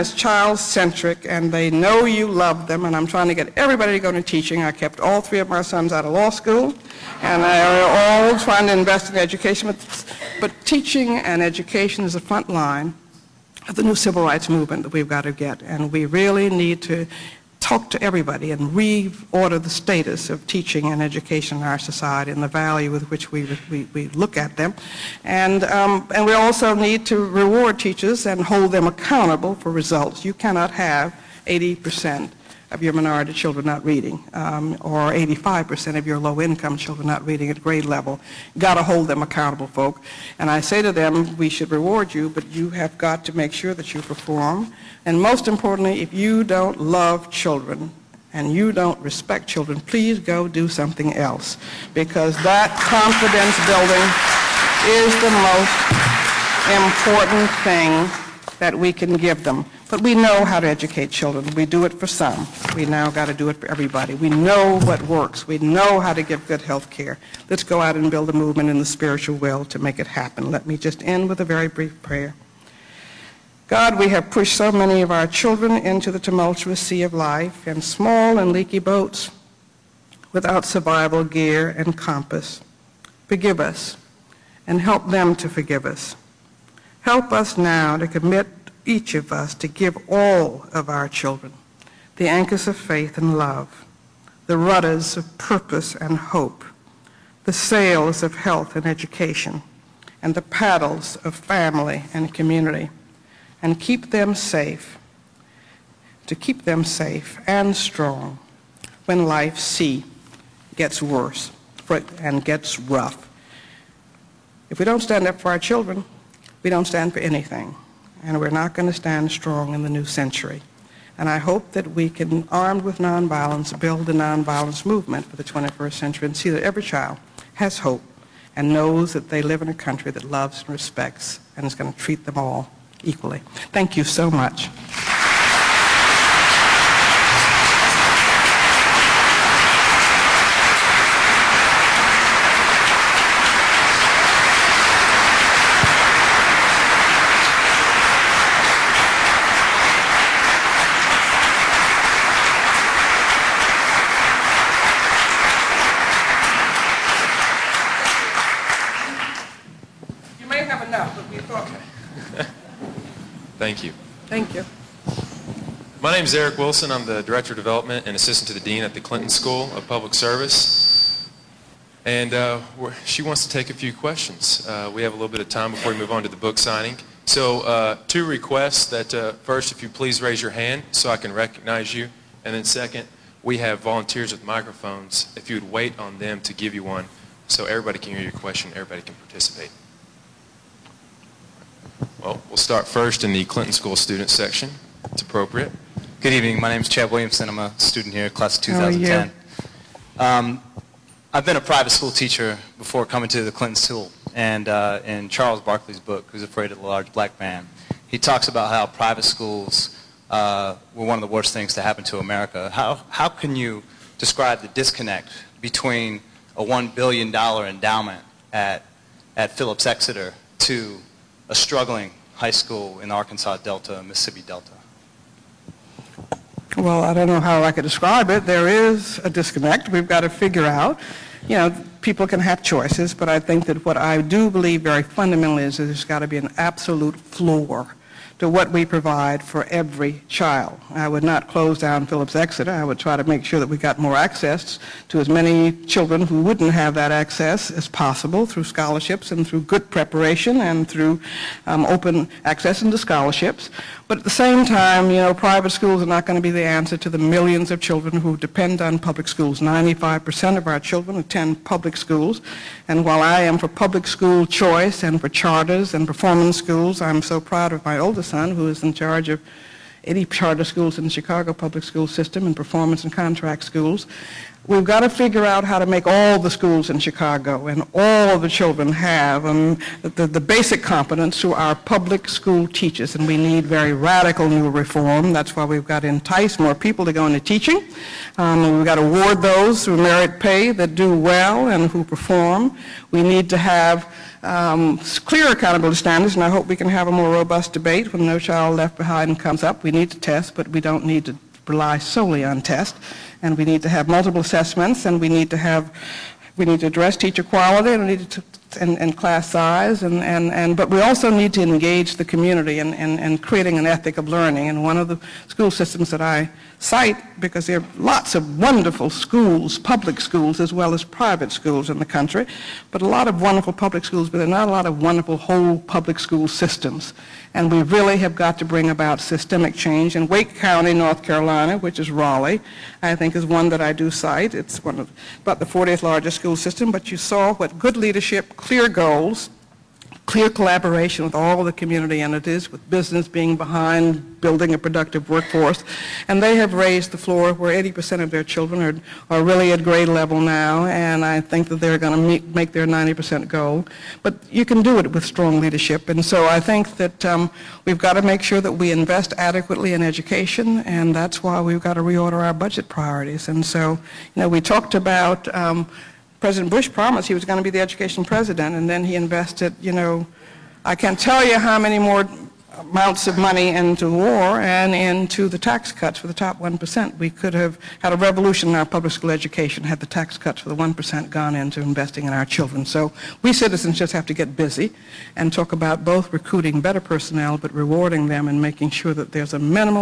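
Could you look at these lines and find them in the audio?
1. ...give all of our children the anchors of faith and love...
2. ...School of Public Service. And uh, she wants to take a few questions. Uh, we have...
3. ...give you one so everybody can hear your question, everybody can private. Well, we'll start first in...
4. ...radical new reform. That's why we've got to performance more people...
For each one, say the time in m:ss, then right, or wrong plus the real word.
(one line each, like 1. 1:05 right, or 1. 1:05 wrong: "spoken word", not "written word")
1. 1:29 right
2. 2:49 right
3. 3:06 wrong: "participate", not "private"
4. 4:43 wrong: "entice", not "performance".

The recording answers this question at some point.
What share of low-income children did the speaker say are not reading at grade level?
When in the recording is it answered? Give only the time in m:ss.
0:35.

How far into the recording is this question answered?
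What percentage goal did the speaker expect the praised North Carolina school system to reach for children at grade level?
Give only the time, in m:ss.
5:52.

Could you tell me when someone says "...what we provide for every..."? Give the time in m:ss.
3:58.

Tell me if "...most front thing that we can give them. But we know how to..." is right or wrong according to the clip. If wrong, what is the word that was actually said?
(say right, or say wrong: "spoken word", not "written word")
wrong: "important", not "front".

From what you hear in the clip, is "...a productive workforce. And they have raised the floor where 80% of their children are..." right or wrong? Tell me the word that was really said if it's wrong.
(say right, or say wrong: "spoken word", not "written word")
right.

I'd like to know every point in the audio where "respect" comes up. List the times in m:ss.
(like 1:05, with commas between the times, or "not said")
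0:48, 2:10.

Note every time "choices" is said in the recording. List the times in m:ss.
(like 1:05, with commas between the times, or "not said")
3:52, 4:24.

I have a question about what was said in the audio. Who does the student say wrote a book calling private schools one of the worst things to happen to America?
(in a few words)
Charles Barkley.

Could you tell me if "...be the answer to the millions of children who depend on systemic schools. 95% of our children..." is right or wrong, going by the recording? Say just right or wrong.
wrong.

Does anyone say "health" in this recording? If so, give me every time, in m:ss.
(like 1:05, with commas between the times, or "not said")
1:06, 1:38.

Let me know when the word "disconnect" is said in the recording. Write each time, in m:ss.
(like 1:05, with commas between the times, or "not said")
3:34, 3:49.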